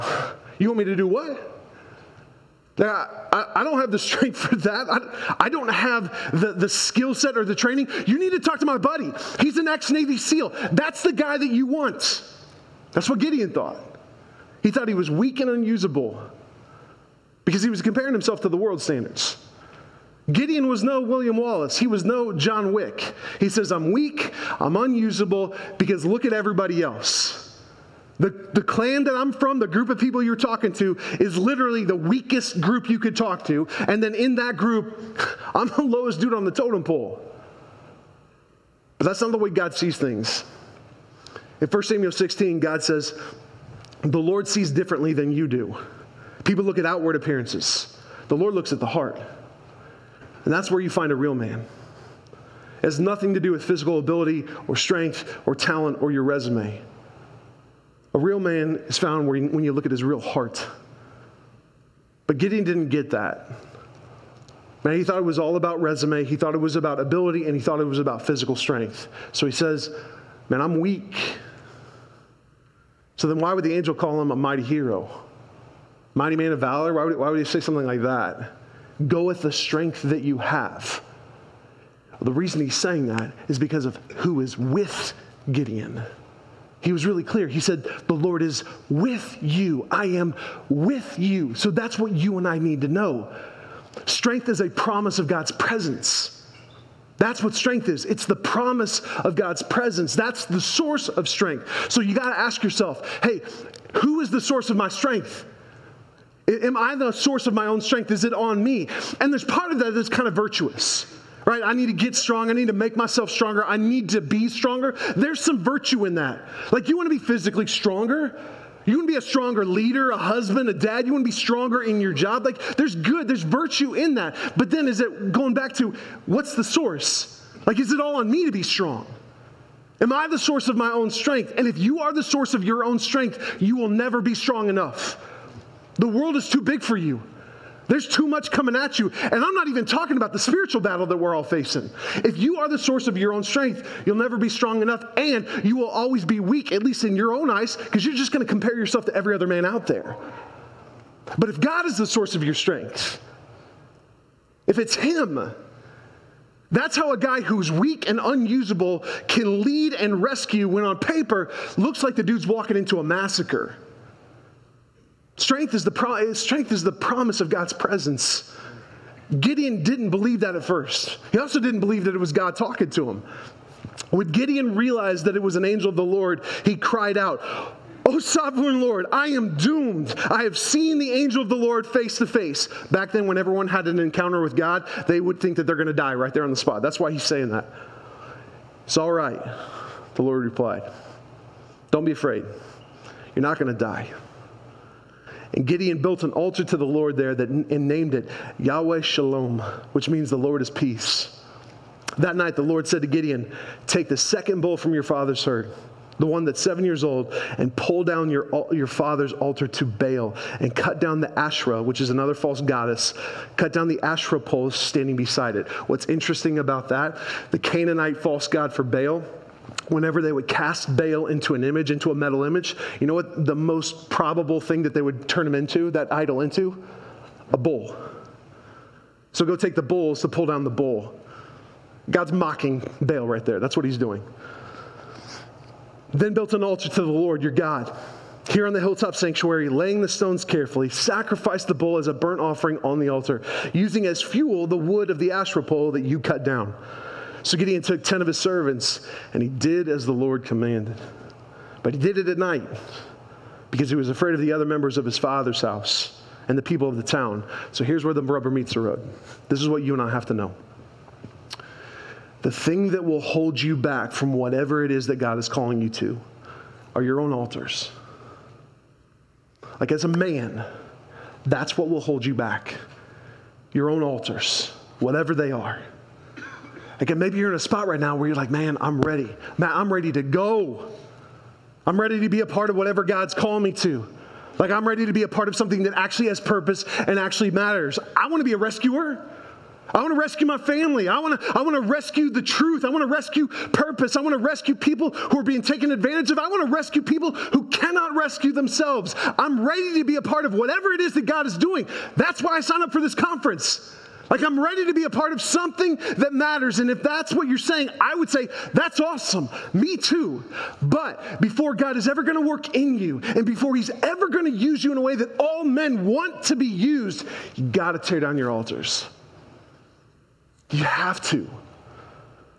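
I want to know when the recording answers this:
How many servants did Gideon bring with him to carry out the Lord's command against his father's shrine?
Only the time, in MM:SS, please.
04:08.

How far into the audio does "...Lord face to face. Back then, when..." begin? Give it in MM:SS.
03:01.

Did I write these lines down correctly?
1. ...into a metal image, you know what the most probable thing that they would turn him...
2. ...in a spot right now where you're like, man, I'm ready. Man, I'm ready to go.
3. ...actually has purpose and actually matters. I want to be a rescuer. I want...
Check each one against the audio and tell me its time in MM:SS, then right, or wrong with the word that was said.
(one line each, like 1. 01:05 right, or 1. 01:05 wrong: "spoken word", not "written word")
1. 03:41 right
2. 04:37 right
3. 04:45 right.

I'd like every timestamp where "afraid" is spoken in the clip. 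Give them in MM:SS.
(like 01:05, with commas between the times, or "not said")
03:12, 04:14.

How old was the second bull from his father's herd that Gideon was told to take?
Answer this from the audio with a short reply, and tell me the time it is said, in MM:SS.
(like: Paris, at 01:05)
7 years old, at 03:26.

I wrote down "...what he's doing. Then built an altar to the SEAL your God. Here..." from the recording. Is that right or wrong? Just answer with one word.
wrong.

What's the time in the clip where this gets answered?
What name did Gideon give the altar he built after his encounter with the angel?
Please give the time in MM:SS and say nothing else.
03:18.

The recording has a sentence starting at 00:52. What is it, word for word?
It has nothing to do with physical ability or strength or talent or your resume.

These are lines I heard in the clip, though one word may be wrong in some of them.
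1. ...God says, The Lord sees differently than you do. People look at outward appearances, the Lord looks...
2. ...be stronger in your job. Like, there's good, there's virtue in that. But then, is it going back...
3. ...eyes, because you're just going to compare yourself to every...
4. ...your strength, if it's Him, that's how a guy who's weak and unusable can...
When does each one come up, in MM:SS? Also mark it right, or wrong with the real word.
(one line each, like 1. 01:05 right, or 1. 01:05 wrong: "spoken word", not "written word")
1. 00:42 right
2. 02:01 right
3. 02:27 right
4. 02:32 right.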